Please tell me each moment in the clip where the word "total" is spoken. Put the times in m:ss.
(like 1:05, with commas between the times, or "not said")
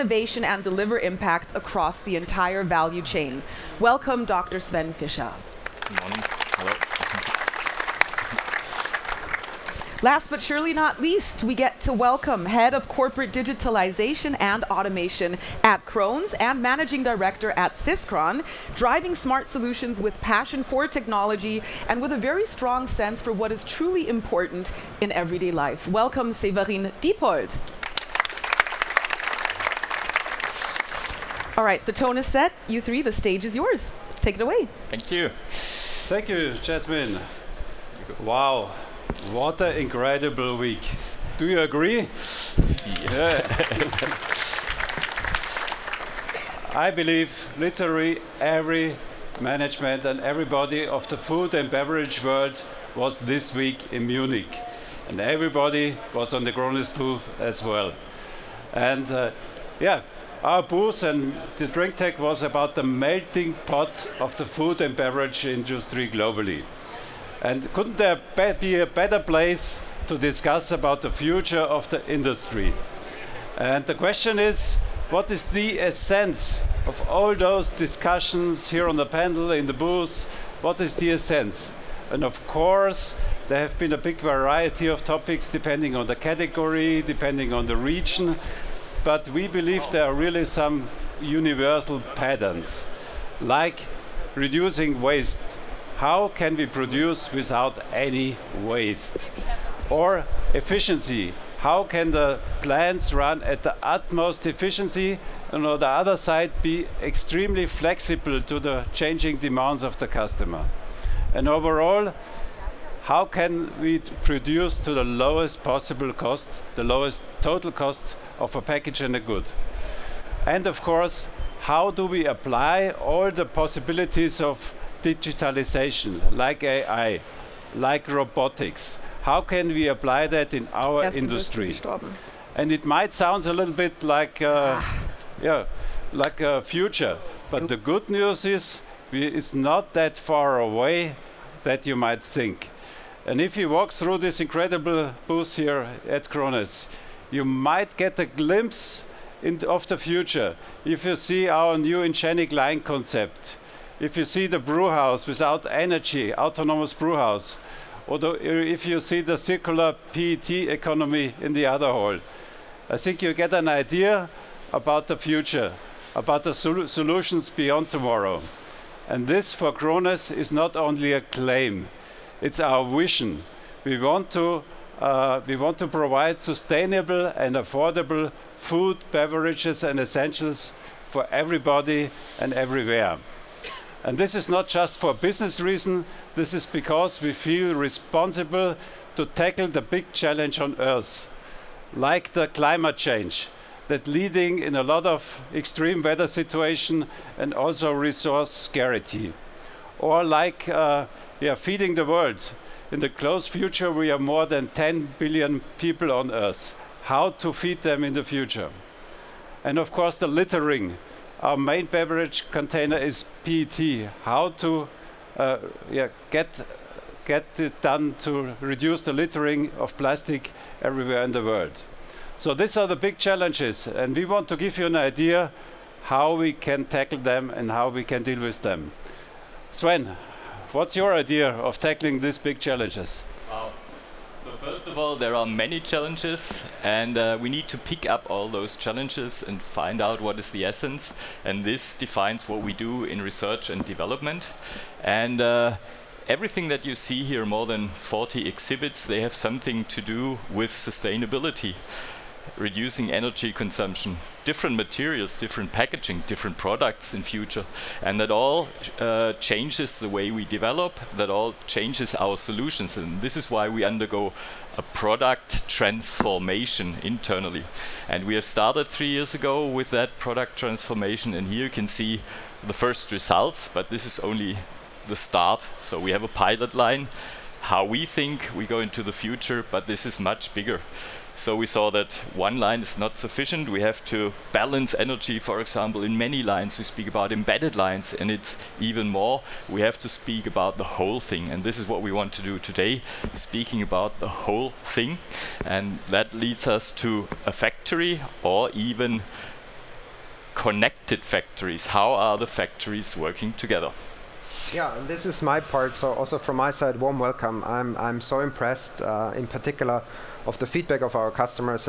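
1:57.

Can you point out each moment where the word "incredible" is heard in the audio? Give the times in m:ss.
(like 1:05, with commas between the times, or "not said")
0:39, 2:24.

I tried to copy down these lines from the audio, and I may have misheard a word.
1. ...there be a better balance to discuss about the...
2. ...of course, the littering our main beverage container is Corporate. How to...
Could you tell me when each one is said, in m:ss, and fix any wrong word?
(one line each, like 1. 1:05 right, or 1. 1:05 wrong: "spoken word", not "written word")
1. 1:07 wrong: "place", not "balance"
2. 3:29 wrong: "PET", not "Corporate".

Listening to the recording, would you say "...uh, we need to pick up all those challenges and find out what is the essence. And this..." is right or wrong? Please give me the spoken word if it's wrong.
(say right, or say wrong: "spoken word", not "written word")
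right.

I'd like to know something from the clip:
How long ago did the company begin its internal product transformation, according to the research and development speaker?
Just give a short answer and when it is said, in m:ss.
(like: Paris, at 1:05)
three years ago, at 4:28.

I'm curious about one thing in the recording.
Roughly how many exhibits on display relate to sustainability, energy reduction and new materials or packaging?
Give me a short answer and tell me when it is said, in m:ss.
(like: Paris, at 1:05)
more than 40, at 4:07.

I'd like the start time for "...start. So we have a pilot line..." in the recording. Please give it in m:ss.
4:35.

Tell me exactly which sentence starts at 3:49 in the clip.
Sven, what's your idea of tackling these big challenges?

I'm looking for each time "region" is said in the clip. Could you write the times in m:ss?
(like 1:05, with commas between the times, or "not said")
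1:27.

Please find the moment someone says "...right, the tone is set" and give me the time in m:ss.
0:31.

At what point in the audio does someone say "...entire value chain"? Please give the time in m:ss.
0:02.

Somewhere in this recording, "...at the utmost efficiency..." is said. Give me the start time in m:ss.
1:43.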